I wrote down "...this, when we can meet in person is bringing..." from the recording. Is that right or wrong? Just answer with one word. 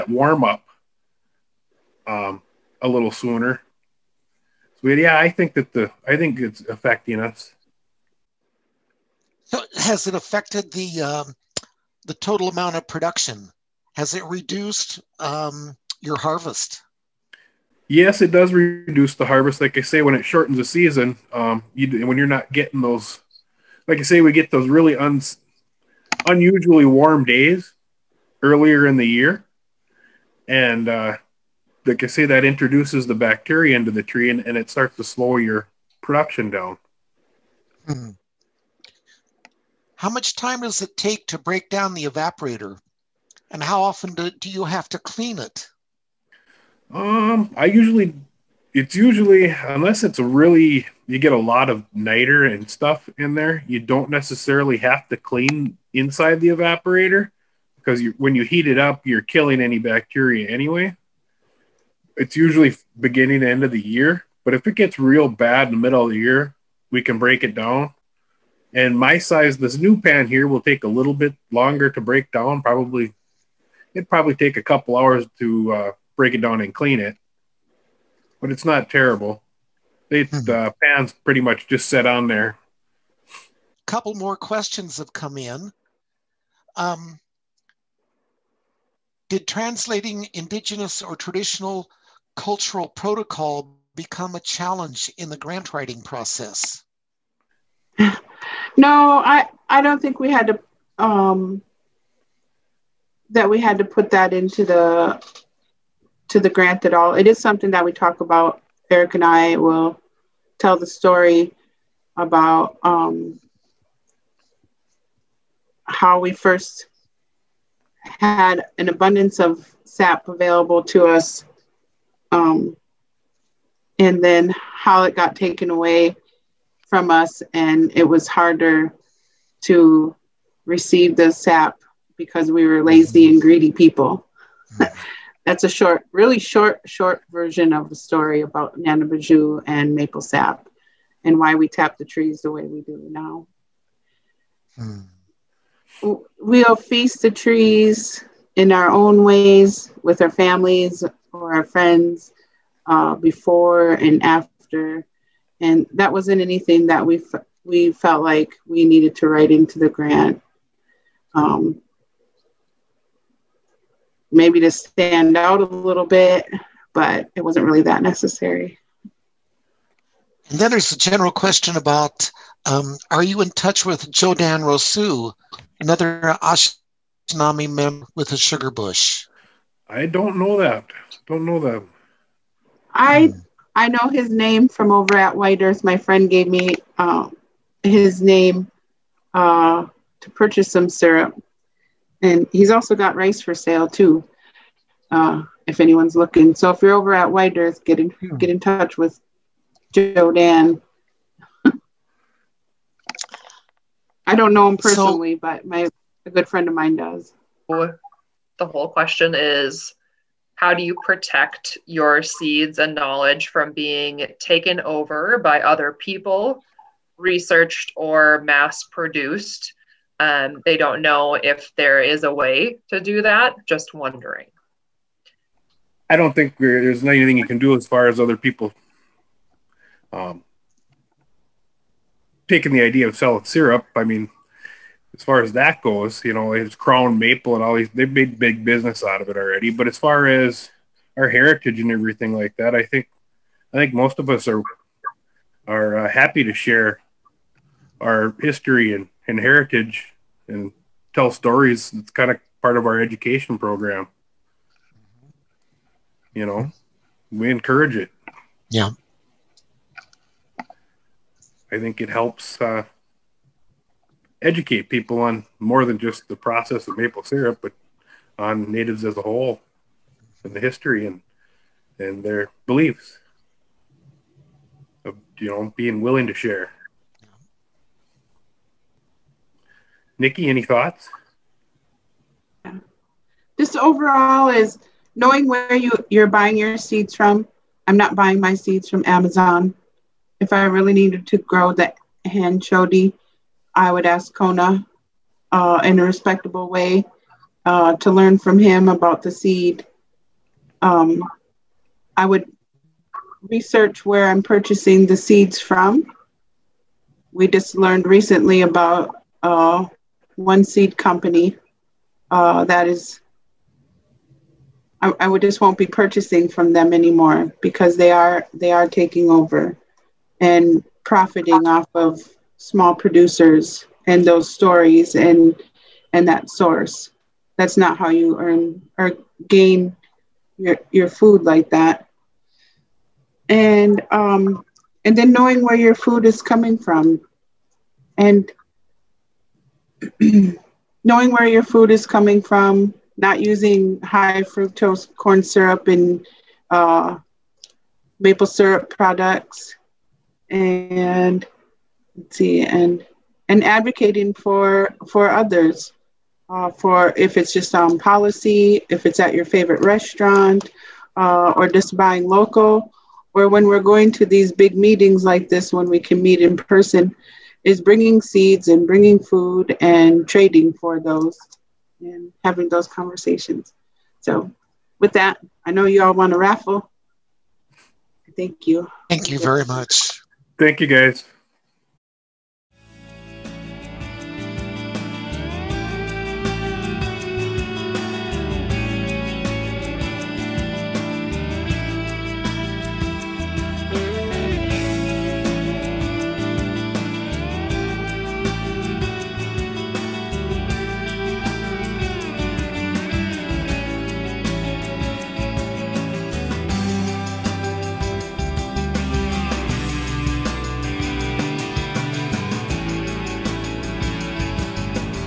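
right.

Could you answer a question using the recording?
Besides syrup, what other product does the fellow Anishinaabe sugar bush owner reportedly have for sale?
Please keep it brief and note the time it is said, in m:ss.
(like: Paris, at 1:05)
rice, at 3:13.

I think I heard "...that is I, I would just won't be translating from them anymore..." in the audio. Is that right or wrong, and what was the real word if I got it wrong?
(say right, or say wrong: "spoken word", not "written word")
wrong: "purchasing", not "translating".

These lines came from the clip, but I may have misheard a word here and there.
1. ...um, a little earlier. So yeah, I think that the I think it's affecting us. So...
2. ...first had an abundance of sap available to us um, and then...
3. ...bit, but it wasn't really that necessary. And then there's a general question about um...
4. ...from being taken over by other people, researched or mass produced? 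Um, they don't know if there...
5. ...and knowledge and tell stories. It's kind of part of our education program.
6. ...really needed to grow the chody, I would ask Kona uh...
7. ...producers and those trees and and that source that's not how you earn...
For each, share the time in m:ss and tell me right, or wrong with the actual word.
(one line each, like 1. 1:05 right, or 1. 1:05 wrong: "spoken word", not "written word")
1. 0:02 wrong: "sooner", not "earlier"
2. 1:56 right
3. 2:46 right
4. 3:33 right
5. 4:09 wrong: "heritage", not "knowledge"
6. 4:50 right
7. 5:22 wrong: "stories", not "trees".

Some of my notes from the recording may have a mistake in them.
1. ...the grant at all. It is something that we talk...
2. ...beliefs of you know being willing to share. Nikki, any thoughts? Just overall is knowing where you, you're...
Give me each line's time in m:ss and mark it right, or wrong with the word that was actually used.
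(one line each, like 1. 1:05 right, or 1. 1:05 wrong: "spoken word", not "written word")
1. 1:46 right
2. 4:32 right.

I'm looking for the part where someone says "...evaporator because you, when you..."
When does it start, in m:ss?
0:56.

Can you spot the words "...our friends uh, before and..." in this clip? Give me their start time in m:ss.
2:31.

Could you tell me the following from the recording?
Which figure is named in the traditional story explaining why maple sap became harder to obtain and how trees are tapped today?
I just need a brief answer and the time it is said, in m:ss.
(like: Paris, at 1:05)
Nanabiju, at 2:18.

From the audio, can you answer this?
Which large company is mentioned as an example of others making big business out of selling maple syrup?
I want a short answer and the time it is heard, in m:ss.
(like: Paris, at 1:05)
Crown Maple, at 3:56.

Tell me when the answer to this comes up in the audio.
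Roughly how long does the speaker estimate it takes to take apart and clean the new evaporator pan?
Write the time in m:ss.
1:14.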